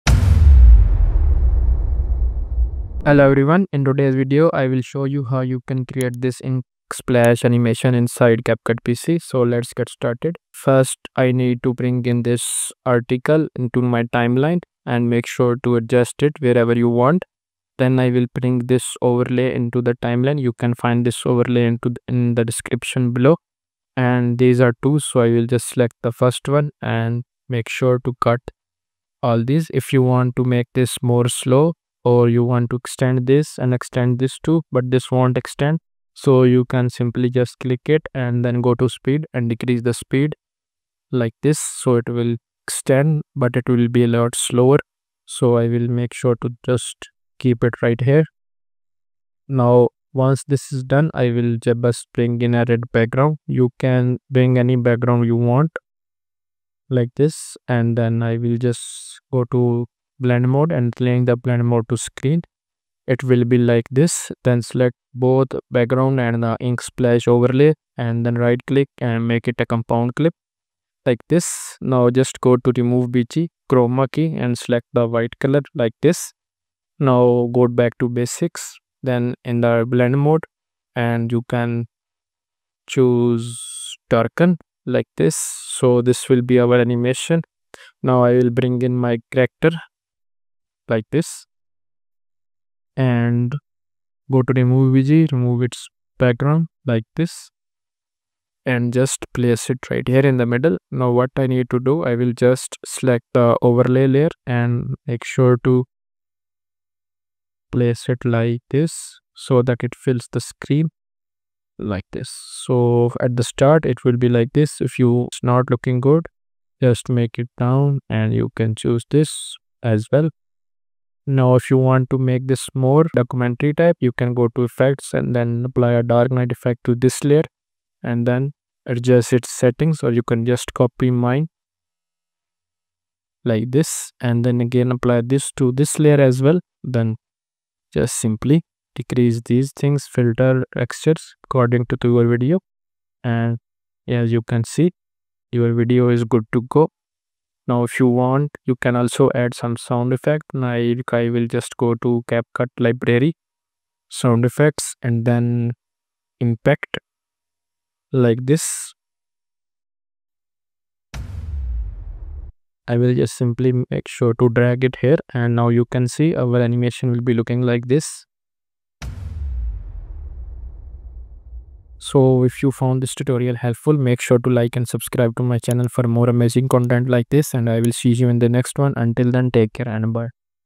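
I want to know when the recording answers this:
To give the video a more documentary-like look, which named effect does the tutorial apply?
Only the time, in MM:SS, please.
02:06.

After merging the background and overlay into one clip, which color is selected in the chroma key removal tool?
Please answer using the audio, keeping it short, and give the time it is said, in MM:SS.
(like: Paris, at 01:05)
White, at 01:15.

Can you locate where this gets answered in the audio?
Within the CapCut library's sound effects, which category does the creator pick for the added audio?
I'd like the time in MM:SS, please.
02:36.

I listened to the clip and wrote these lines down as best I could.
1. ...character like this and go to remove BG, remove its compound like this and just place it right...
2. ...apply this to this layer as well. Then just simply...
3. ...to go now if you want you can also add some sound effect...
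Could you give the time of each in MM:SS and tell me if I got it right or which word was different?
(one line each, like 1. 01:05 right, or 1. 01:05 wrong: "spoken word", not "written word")
1. 01:29 wrong: "background", not "compound"
2. 02:14 right
3. 02:26 right.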